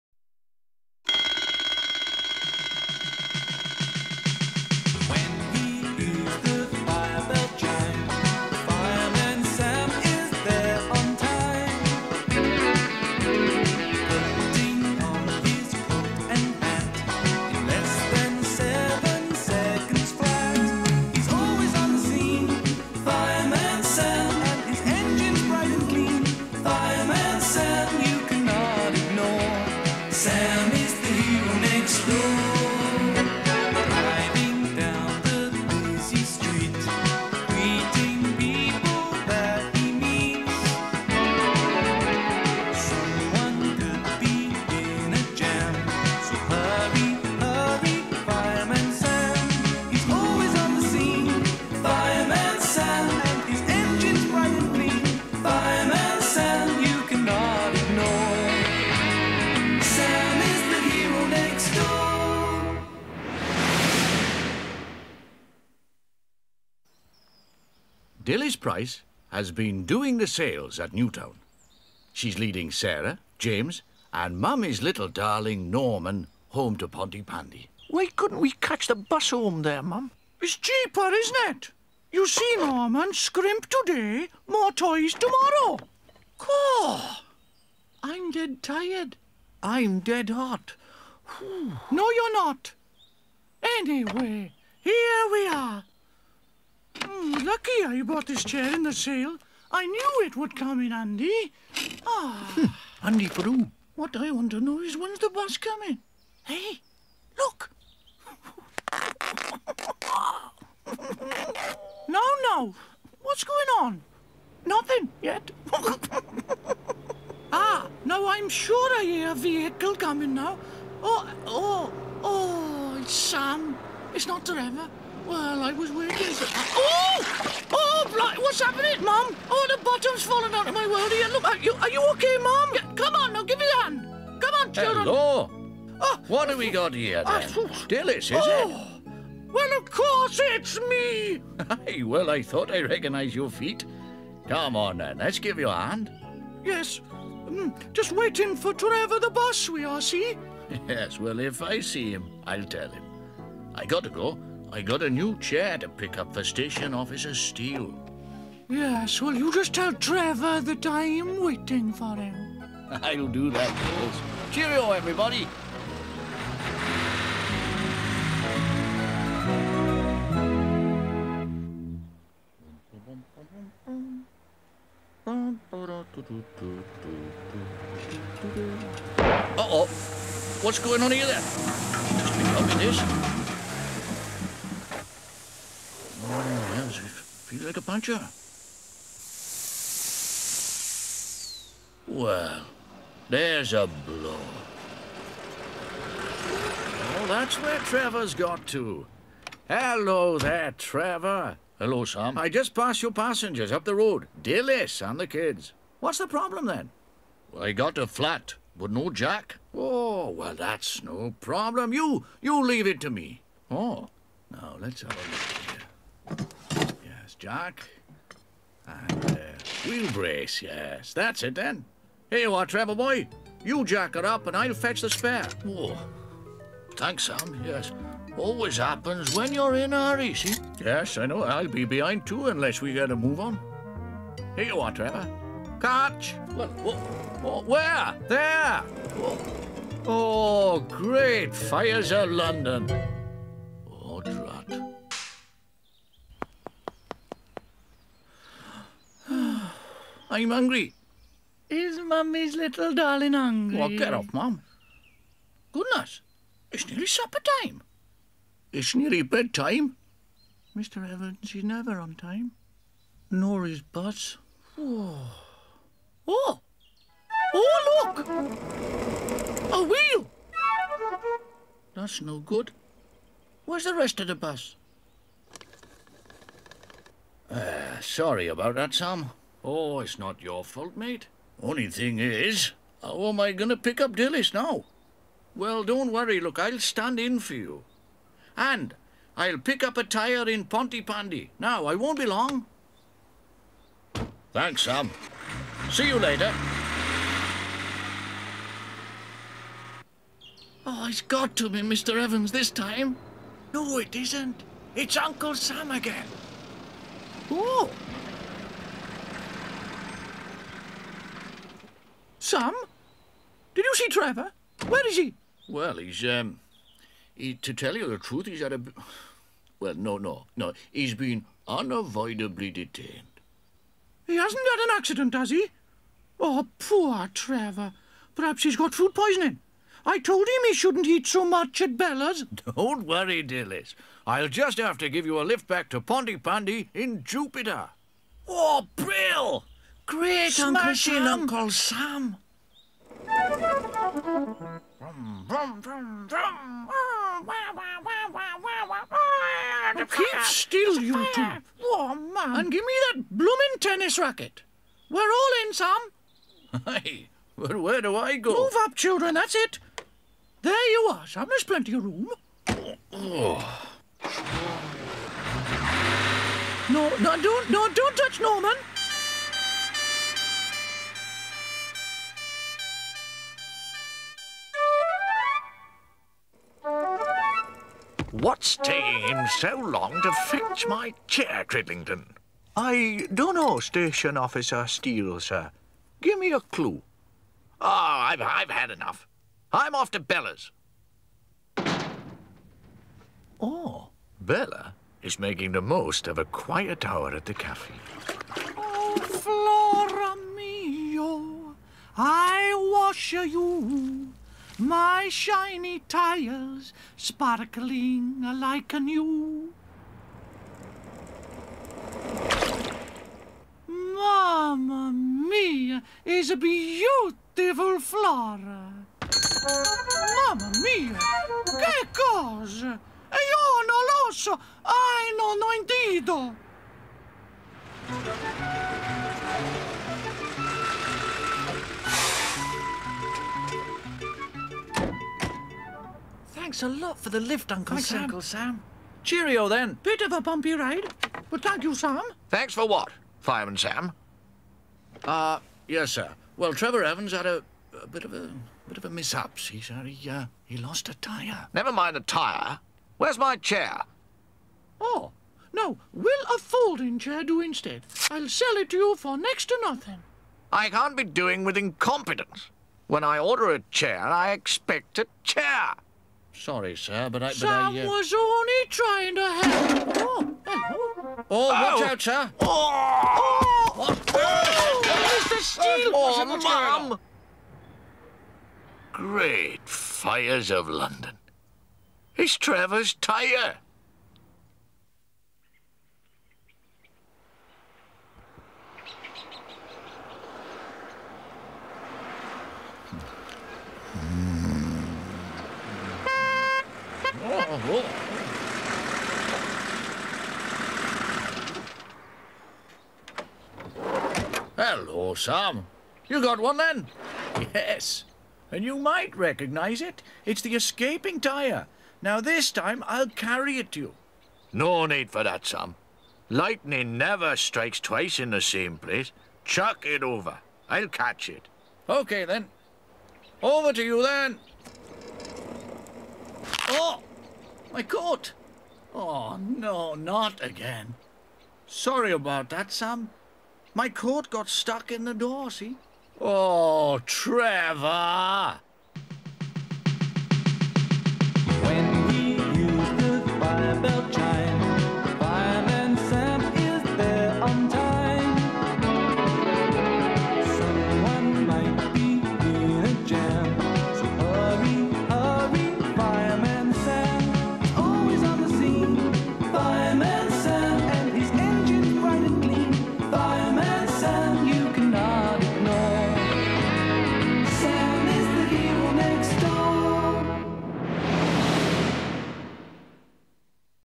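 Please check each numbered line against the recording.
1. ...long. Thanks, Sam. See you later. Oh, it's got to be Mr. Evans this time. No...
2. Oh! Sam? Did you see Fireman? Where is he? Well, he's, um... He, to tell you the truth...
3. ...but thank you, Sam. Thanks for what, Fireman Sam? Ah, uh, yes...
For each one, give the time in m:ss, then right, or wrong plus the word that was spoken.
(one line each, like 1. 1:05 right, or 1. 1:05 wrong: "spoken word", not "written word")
1. 4:52 right
2. 5:07 wrong: "Trevor", not "Fireman"
3. 7:21 right.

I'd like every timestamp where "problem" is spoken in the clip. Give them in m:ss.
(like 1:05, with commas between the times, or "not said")
3:26, 3:31.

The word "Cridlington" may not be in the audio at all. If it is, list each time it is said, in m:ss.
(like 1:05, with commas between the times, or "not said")
6:21.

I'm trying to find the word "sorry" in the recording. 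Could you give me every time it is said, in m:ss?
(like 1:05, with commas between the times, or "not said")
4:37, 7:46, 8:51.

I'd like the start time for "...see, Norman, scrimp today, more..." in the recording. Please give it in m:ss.
1:22.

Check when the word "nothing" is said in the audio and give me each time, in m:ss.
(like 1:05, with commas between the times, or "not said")
1:54, 7:39.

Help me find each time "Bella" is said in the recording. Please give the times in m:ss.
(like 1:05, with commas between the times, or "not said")
5:31, 6:30, 6:34.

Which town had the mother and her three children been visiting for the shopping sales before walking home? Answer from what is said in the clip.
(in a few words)
Newtown.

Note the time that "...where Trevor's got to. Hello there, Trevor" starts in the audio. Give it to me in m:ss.
3:17.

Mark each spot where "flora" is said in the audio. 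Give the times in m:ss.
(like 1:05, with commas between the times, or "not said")
6:39, 6:57.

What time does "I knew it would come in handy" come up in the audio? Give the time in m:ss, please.
1:39.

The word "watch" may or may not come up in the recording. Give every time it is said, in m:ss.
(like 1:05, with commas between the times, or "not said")
7:51.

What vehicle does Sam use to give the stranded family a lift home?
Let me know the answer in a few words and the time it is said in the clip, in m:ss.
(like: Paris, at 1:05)
Jupiter, at 5:37.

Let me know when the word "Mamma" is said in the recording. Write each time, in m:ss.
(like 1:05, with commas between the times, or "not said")
6:53, 7:00.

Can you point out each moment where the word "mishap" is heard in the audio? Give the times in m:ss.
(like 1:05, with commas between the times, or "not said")
7:29.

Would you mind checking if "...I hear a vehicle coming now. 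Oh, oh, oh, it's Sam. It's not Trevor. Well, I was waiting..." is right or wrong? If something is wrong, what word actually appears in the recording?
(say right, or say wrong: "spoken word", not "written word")
right.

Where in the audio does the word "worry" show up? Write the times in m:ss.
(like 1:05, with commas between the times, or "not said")
4:46, 5:33.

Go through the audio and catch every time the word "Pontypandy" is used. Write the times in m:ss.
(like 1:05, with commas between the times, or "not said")
1:16, 4:50, 5:36.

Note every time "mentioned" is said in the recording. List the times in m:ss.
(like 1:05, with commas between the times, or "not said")
not said.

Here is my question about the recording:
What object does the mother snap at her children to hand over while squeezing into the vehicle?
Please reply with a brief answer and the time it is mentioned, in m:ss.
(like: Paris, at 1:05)
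Tennis racket, at 5:53.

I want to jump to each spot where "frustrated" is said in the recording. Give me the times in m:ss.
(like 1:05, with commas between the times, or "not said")
not said.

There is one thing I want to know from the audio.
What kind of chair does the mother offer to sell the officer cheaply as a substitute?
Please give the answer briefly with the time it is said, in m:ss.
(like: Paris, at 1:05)
Folding chair, at 7:36.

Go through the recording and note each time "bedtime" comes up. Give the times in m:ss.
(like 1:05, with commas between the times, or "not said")
4:19.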